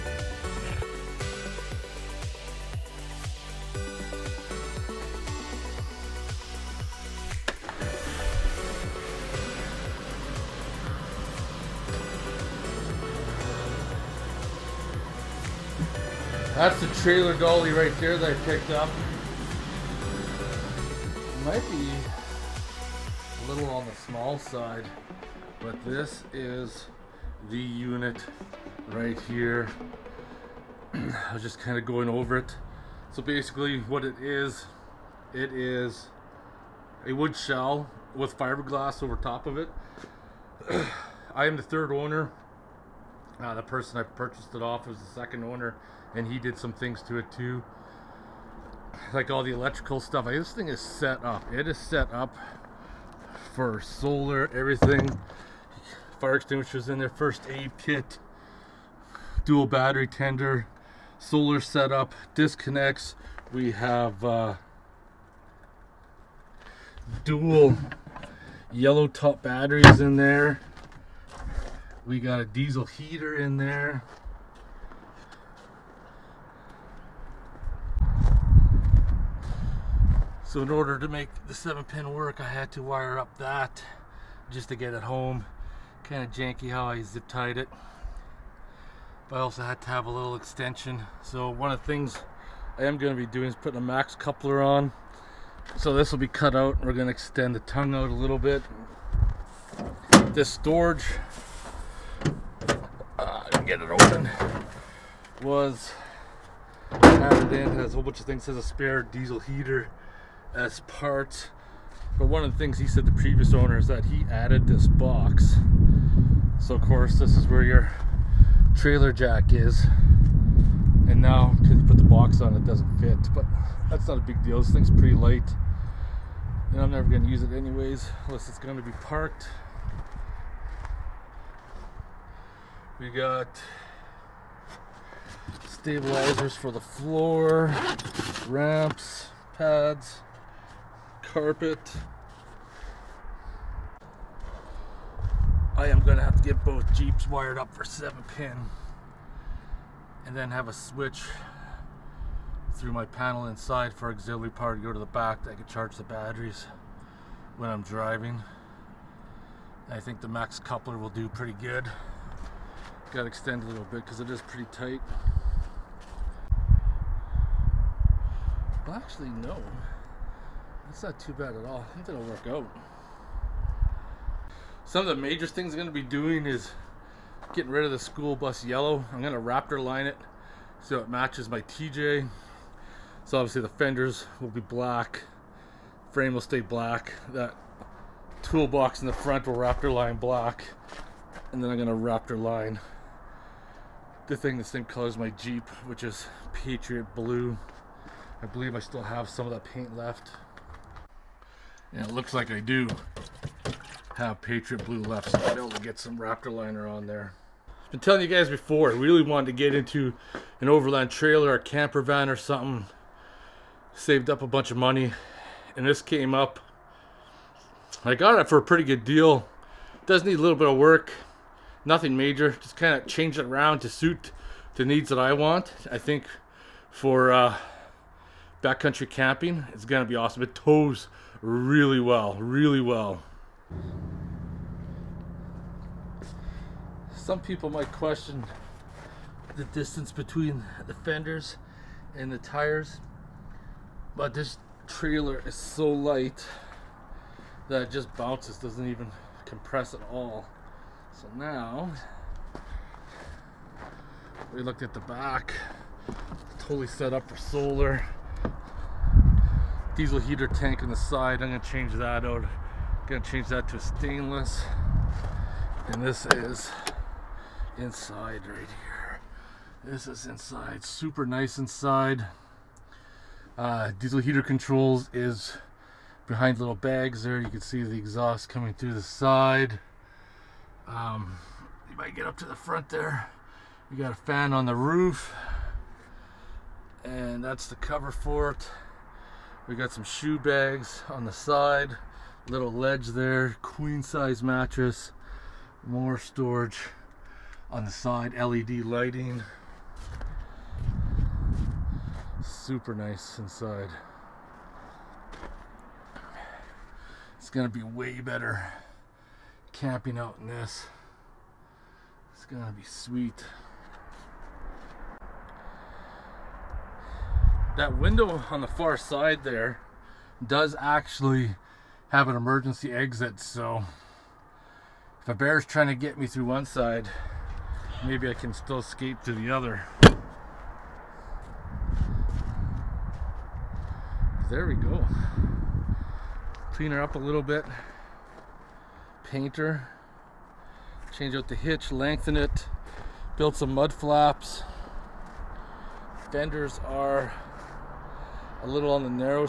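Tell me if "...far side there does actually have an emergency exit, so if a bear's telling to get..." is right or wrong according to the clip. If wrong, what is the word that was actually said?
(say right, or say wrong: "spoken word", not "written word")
wrong: "trying", not "telling".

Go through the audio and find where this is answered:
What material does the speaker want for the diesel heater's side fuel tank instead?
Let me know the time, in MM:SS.
04:23.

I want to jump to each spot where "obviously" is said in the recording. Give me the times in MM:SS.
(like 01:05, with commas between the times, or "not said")
03:03.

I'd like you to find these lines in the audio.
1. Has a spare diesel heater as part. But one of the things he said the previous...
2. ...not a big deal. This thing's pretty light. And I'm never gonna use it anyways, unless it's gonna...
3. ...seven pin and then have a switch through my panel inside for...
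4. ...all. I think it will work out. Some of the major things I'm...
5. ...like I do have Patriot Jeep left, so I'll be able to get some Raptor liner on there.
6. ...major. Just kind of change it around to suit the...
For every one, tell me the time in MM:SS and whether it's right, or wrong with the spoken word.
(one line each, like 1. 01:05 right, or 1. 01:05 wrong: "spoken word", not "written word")
1. 01:48 right
2. 02:04 right
3. 02:27 right
4. 02:51 right
5. 03:22 wrong: "Blue", not "Jeep"
6. 03:42 right.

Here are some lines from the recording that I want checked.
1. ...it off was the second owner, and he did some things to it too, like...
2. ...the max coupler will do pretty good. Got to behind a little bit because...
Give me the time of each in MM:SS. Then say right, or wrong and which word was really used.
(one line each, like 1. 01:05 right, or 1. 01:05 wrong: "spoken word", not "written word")
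1. 00:44 right
2. 02:40 wrong: "extend", not "behind".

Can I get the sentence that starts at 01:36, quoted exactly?
We're going to extend the tongue out a little bit.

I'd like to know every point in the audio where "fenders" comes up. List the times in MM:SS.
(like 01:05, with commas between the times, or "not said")
03:03, 04:00, 05:46.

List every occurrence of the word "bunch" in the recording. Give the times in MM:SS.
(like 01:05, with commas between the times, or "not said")
01:48, 03:34.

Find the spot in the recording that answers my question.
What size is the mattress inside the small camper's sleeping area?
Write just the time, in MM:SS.
04:53.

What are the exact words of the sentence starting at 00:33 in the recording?
So basically what it is, it is a wood shell with fiberglass over top of it.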